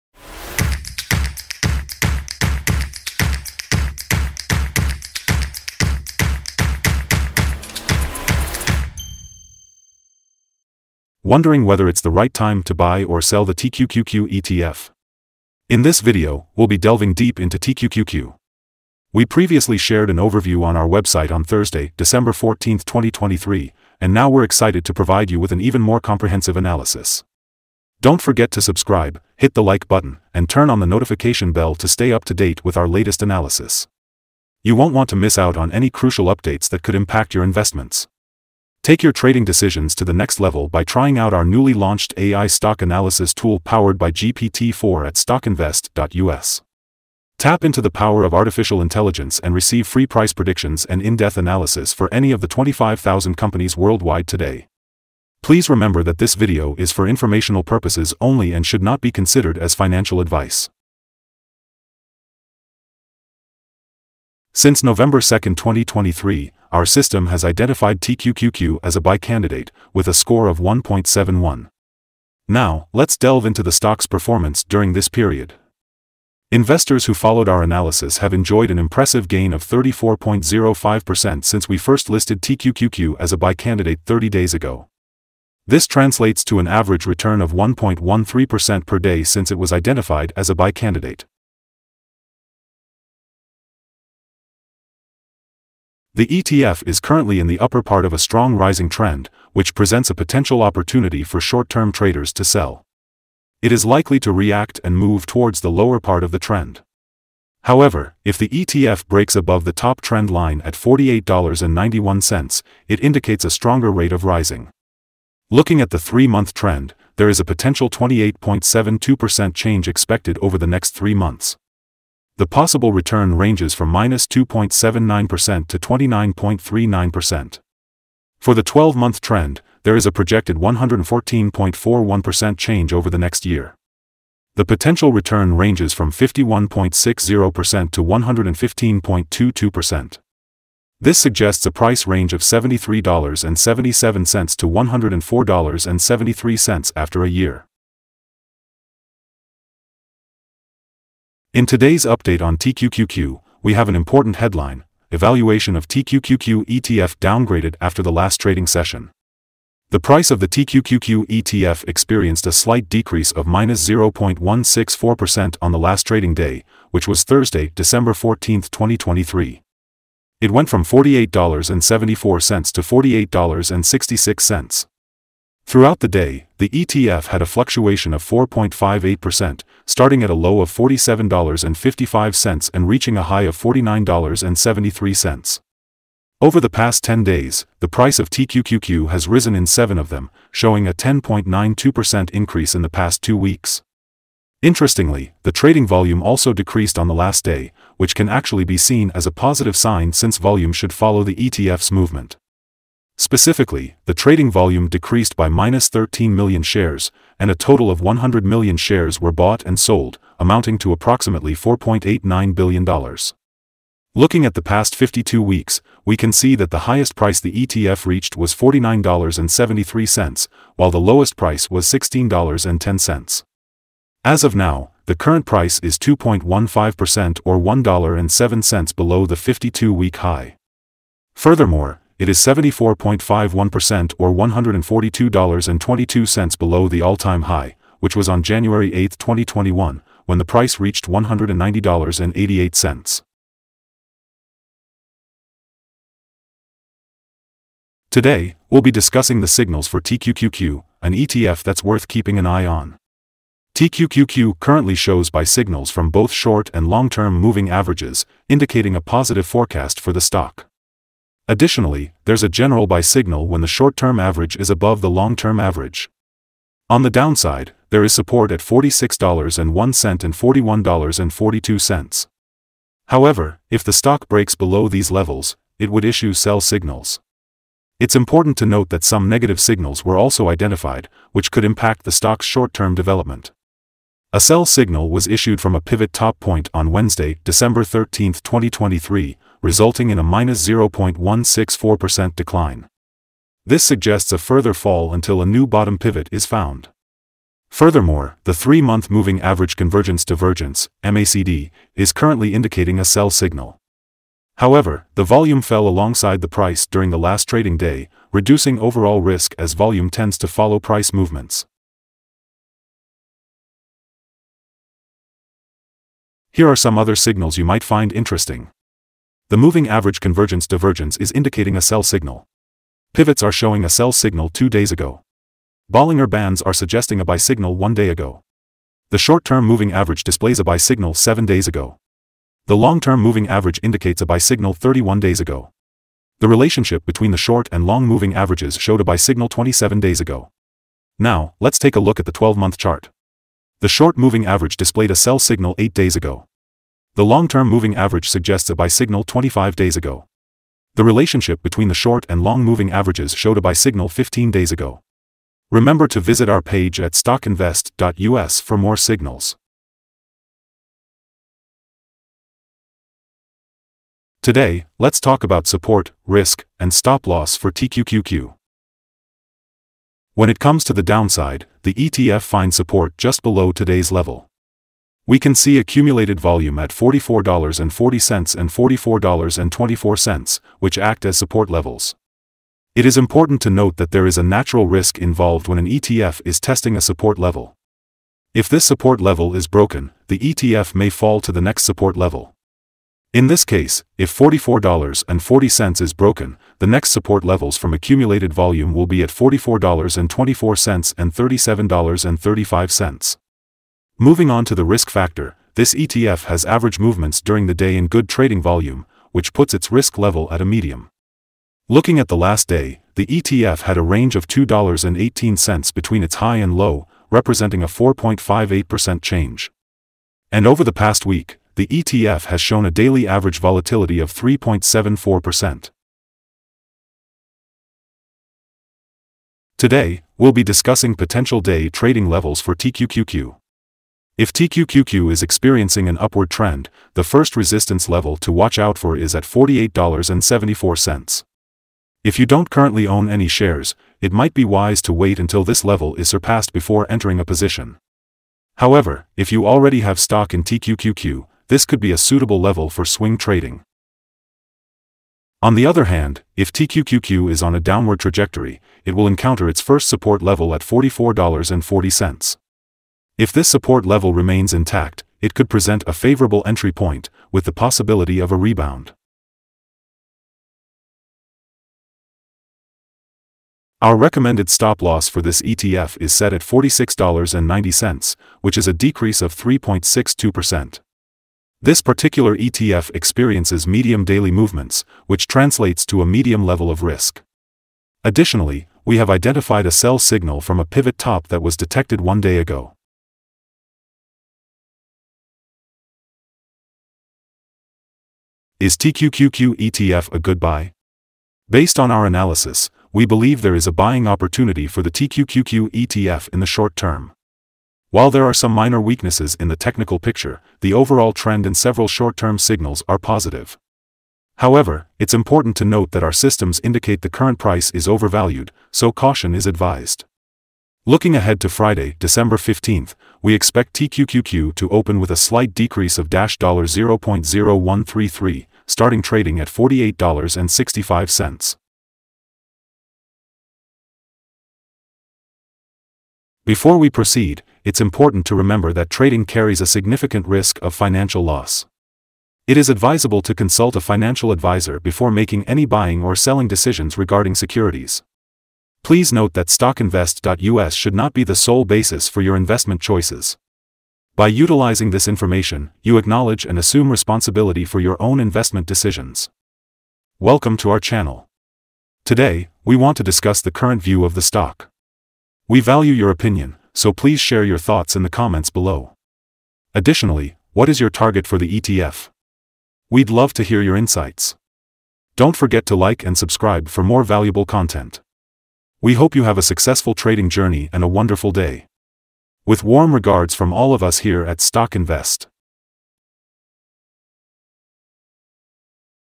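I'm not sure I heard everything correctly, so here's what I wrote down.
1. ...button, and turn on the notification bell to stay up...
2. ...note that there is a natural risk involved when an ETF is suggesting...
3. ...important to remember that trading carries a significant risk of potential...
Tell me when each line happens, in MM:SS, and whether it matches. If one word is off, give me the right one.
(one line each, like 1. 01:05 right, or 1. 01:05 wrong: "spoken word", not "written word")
1. 00:29 right
2. 06:23 wrong: "testing", not "suggesting"
3. 08:58 wrong: "financial", not "potential".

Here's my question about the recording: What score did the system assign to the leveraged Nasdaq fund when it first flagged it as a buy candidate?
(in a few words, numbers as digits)
1.71.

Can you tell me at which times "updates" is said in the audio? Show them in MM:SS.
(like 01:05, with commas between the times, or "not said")
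00:36, 02:32.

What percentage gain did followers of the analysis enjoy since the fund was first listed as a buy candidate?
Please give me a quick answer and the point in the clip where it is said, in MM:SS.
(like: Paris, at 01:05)
34.05%, at 01:19.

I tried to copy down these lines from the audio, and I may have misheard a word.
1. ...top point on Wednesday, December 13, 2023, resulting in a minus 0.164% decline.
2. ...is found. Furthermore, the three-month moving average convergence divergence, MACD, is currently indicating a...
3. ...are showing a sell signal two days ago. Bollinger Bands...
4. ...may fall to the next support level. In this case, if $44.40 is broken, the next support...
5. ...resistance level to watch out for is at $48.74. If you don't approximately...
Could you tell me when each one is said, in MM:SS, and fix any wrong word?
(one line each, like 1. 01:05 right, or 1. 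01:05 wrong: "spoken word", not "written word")
1. 04:46 right
2. 04:56 right
3. 05:23 right
4. 06:30 right
5. 07:17 wrong: "currently", not "approximately".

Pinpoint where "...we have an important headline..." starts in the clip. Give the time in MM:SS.
02:33.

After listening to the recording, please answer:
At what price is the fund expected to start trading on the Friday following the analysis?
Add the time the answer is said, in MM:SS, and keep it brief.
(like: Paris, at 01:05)
$48.65, at 08:49.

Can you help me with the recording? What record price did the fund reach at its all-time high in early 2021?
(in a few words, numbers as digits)
$190.88.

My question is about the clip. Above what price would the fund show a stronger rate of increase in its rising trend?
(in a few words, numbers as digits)
$48.91.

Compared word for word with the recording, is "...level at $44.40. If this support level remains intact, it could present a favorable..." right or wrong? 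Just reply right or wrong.
right.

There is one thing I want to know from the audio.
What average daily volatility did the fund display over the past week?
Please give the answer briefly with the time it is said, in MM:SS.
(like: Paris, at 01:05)
3.74%, at 07:04.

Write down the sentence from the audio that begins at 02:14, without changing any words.
The potential return ranges from 51.60% to 115.22%.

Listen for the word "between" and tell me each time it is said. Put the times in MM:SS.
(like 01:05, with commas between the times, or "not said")
05:37, 05:51, 06:55.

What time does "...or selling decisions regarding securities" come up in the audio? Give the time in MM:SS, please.
09:06.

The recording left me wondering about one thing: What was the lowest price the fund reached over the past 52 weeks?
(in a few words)
$16.10.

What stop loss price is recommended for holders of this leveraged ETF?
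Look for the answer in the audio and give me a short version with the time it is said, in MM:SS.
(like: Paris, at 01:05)
$46.90, at 07:56.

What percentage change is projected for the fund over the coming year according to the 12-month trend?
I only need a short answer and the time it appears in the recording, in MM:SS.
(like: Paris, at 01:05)
114.41%, at 02:10.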